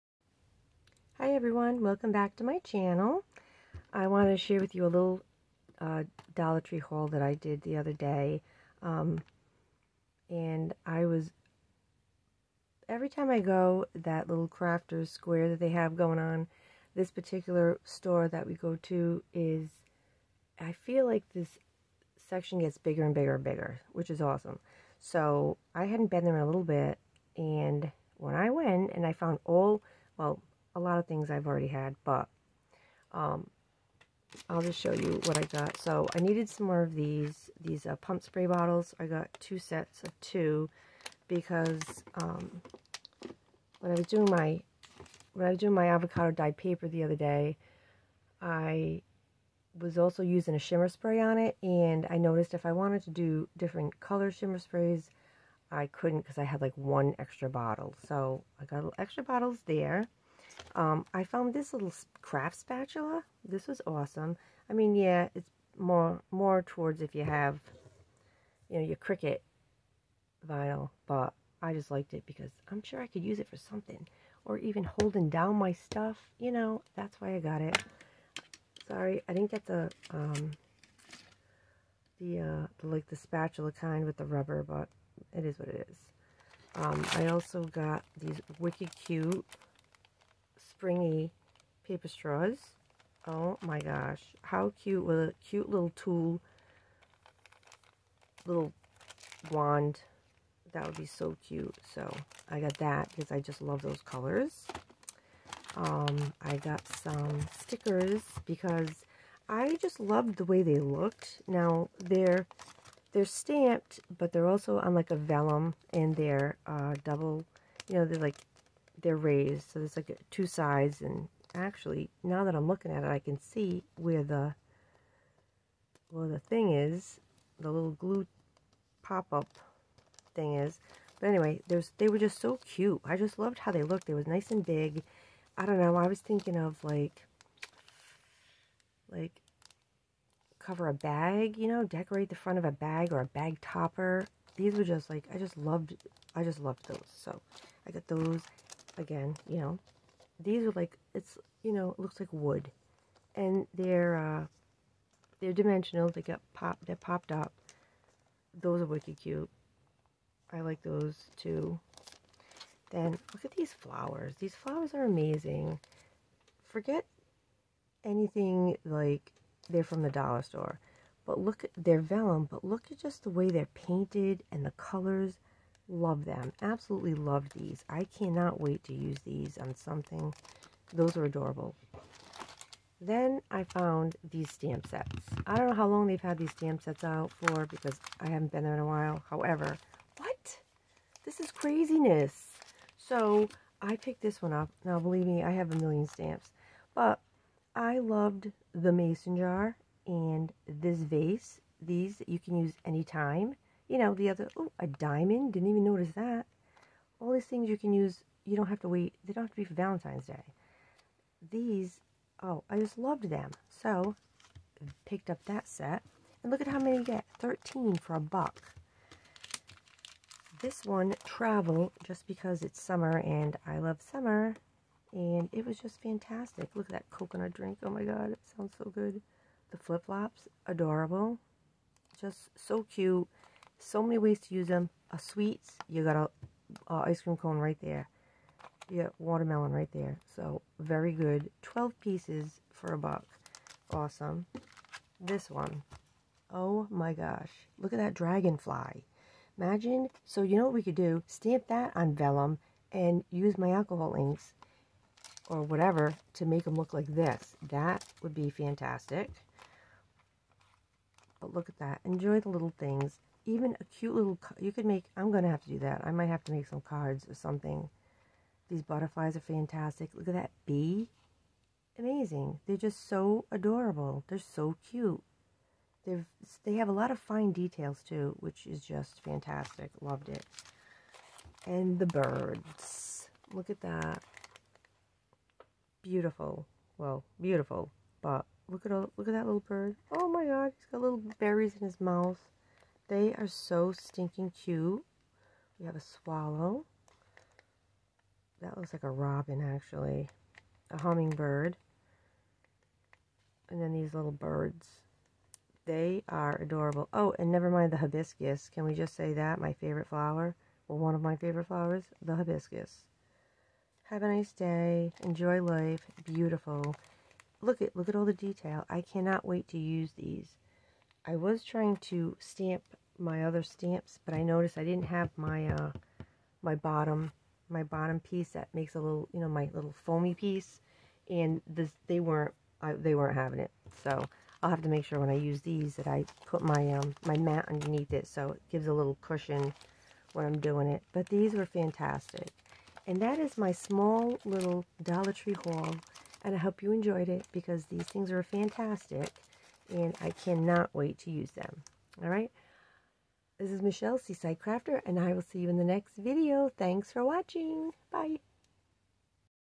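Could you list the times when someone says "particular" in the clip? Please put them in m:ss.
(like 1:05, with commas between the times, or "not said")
0:17.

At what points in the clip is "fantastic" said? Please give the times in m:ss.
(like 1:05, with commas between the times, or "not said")
3:46, 4:18, 4:29, 4:39, 5:41, 5:48.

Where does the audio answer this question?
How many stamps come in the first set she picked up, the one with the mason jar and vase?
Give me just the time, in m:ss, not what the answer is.
3:37.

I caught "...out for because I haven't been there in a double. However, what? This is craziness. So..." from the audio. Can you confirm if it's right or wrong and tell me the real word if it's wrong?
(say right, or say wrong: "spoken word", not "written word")
wrong: "while", not "double".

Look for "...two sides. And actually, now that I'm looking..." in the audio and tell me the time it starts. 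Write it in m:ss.
2:00.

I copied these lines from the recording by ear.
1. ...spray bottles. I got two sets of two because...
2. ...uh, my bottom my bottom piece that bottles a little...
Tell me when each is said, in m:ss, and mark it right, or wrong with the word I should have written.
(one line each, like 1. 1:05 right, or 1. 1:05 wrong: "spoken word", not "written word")
1. 0:38 right
2. 5:25 wrong: "makes", not "bottles".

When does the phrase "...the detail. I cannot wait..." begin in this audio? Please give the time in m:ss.
5:18.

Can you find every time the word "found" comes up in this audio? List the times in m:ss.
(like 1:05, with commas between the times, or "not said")
0:29, 1:01, 3:03.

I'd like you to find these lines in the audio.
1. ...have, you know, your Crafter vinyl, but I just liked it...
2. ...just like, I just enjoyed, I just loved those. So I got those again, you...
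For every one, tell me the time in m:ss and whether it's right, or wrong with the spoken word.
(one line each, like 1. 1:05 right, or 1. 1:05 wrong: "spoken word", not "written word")
1. 1:07 wrong: "Cricut", not "Crafter"
2. 2:24 wrong: "loved", not "enjoyed".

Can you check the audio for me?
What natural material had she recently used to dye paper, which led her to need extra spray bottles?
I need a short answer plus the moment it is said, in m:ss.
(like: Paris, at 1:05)
Avocado, at 0:45.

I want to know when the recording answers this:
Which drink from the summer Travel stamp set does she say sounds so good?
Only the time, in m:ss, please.
3:47.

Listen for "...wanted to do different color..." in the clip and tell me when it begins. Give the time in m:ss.
0:52.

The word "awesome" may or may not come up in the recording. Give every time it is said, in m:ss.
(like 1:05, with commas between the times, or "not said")
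0:24, 1:03, 4:03.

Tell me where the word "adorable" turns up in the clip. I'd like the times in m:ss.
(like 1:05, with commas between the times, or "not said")
3:01, 3:50, 4:33, 5:06.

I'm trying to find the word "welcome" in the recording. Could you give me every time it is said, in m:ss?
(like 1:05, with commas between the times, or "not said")
0:01.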